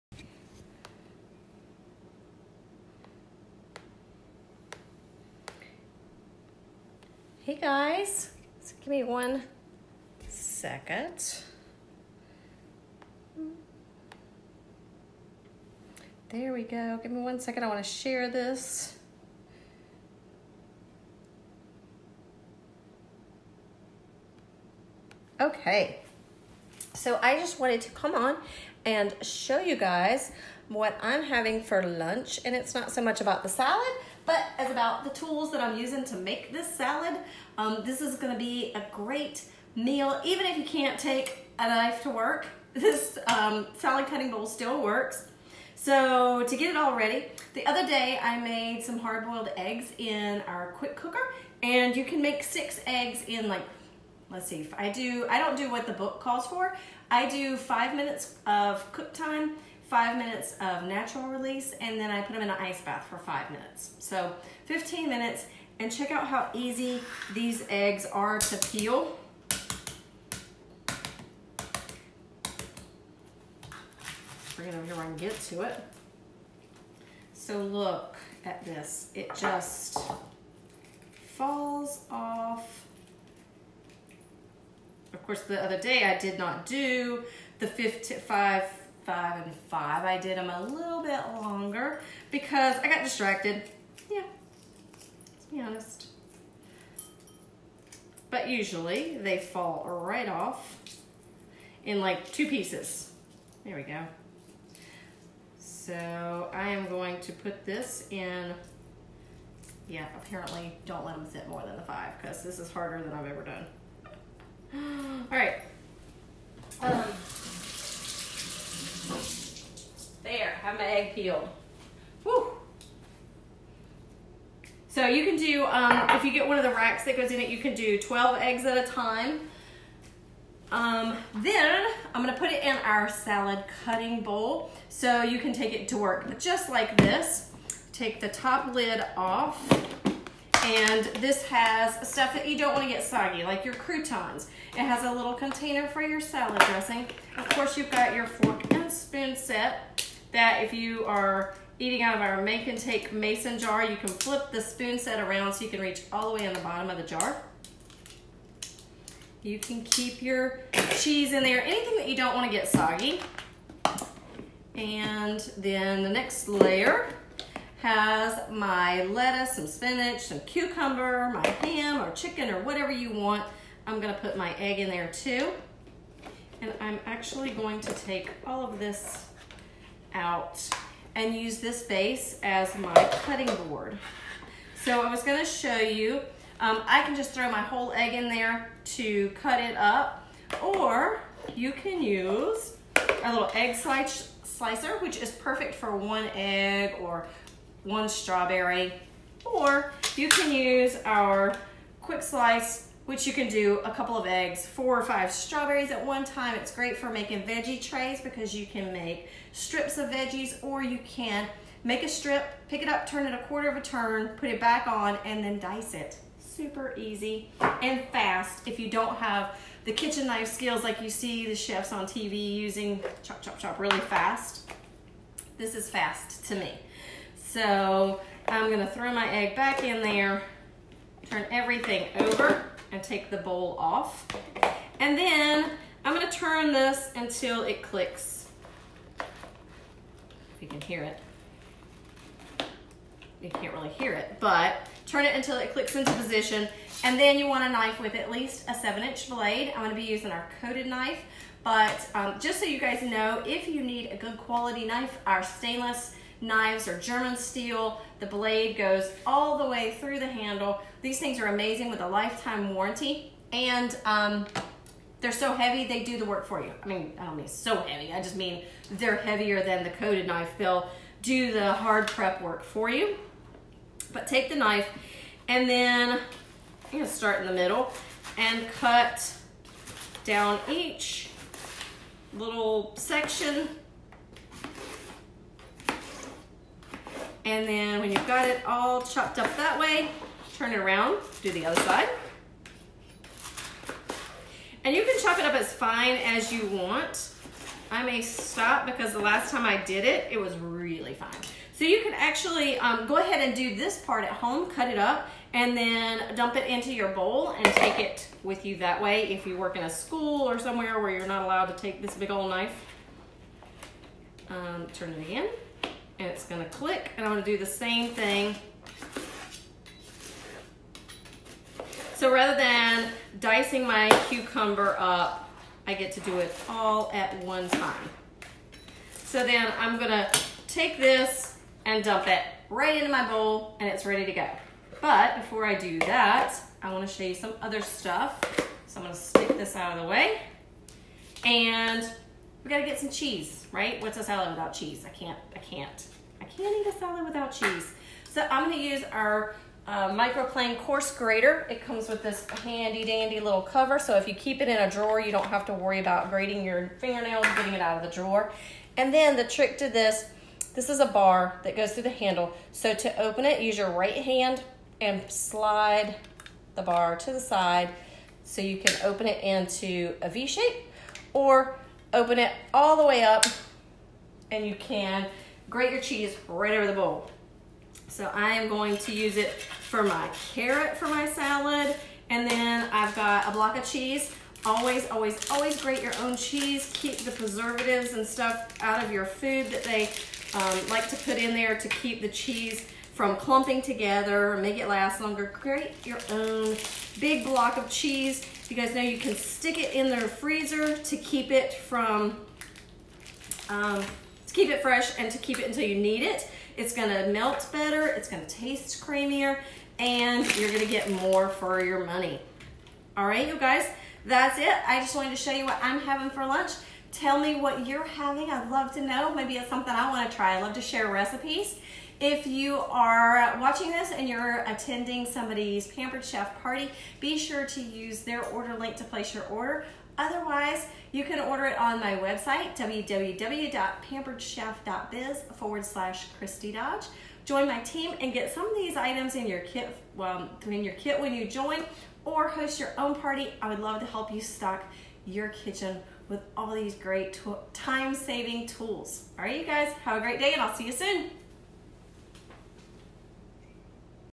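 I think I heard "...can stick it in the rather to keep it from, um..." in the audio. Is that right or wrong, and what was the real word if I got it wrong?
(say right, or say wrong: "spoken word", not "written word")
wrong: "freezer", not "rather".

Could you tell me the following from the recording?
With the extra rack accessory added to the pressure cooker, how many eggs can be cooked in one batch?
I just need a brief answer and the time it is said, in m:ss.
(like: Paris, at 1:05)
12, at 2:07.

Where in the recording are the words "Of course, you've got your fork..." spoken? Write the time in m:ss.
2:27.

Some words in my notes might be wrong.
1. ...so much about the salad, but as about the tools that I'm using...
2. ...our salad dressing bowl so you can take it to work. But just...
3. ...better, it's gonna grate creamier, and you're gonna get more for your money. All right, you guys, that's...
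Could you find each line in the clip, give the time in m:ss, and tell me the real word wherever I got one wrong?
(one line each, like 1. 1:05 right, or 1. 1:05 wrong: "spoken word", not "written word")
1. 0:32 right
2. 2:12 wrong: "cutting", not "dressing"
3. 6:47 wrong: "taste", not "grate".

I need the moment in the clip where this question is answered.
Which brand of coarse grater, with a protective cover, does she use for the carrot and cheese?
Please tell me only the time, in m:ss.
5:50.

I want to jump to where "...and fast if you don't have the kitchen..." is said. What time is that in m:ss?
3:37.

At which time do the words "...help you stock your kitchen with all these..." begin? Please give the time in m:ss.
7:24.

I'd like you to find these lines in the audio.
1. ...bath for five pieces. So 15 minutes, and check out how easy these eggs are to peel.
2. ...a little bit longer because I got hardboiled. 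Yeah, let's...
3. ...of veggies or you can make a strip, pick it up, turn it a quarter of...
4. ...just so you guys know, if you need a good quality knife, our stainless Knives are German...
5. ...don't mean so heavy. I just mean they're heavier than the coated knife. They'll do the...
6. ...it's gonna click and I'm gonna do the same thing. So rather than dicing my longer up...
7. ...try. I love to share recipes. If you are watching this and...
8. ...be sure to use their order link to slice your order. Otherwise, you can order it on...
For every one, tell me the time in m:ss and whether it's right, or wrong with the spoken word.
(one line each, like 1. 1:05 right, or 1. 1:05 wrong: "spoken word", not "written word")
1. 1:02 wrong: "minutes", not "pieces"
2. 1:30 wrong: "distracted", not "hardboiled"
3. 3:29 right
4. 4:12 right
5. 4:27 right
6. 5:16 wrong: "cucumber", not "longer"
7. 7:00 right
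8. 7:07 wrong: "place", not "slice".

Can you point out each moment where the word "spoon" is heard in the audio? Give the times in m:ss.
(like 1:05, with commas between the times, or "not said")
2:28, 2:34.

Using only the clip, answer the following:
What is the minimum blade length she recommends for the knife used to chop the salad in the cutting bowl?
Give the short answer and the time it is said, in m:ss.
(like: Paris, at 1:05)
7 inches, at 4:08.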